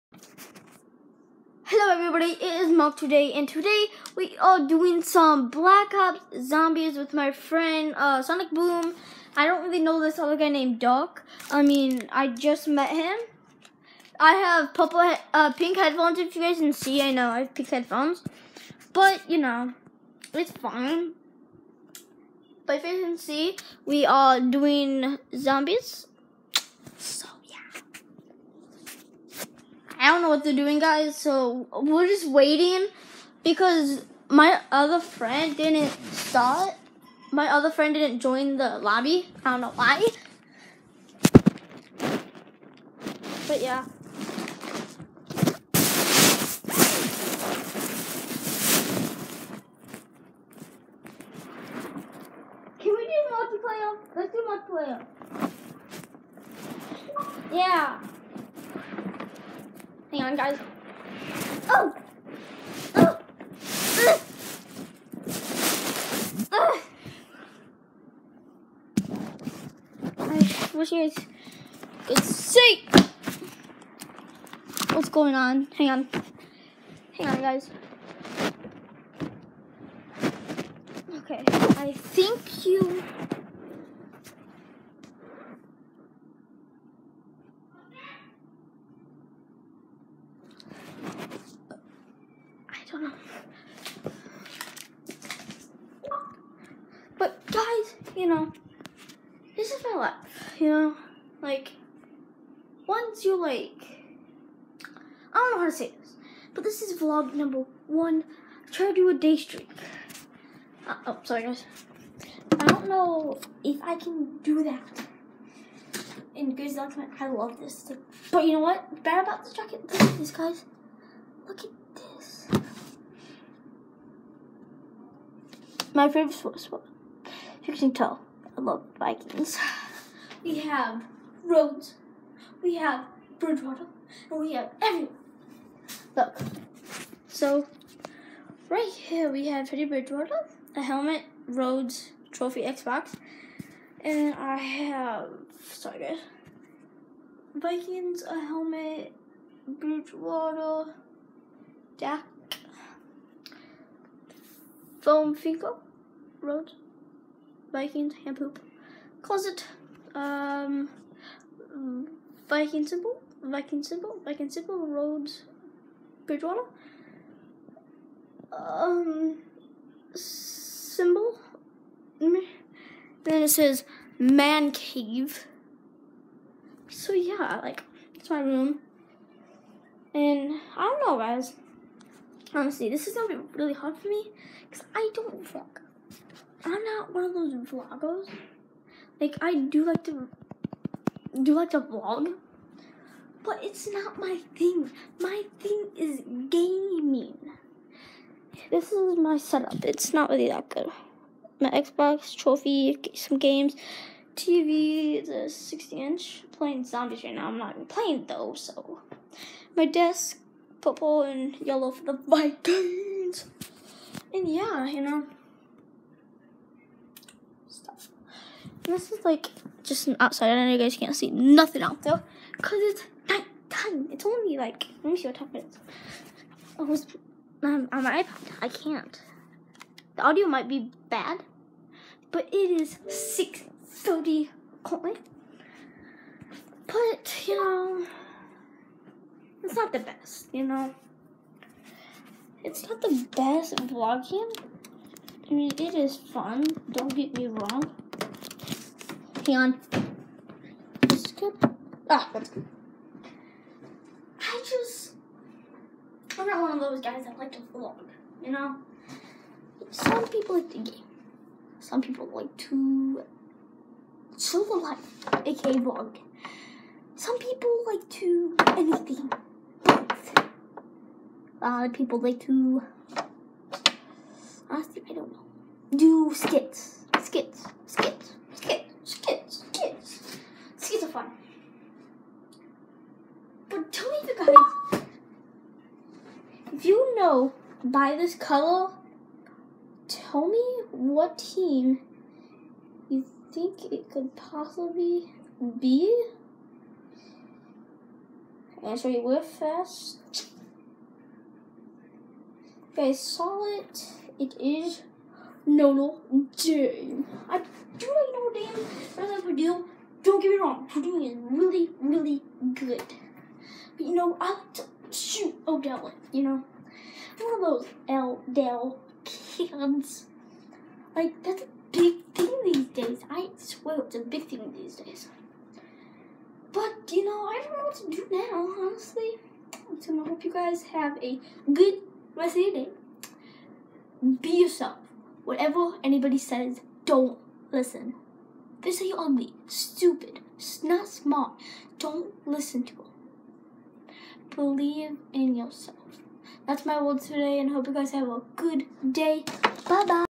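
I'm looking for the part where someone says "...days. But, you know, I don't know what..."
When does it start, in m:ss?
5:24.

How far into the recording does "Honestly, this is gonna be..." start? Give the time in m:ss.
3:02.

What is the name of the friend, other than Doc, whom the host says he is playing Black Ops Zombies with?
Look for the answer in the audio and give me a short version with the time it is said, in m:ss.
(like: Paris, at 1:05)
Sonic Boom, at 0:08.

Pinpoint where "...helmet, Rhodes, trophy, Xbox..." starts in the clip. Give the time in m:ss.
2:20.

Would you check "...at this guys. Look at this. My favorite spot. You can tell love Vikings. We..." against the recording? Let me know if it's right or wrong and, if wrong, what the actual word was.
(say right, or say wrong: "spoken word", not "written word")
right.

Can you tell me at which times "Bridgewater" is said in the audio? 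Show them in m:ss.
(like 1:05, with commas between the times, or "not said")
2:13, 2:19, 2:29, 2:46.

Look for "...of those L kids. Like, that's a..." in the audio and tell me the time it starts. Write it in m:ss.
5:17.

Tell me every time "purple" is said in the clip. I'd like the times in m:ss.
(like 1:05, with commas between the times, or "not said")
0:14, 3:30.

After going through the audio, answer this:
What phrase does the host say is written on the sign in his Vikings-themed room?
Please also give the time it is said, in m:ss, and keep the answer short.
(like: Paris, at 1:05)
man cave, at 2:54.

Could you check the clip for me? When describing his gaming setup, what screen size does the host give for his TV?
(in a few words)
60 inch.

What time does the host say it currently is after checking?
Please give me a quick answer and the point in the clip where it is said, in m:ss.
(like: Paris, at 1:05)
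6:30, at 3:53.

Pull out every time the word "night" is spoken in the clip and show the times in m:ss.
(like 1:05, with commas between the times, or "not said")
3:43.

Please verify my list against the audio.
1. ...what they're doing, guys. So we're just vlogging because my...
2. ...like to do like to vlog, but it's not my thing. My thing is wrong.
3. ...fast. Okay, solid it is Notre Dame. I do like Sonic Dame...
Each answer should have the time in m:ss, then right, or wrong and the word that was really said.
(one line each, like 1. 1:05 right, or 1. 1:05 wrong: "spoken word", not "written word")
1. 0:30 wrong: "waiting", not "vlogging"
2. 3:09 wrong: "gaming", not "wrong"
3. 4:59 wrong: "Notre", not "Sonic".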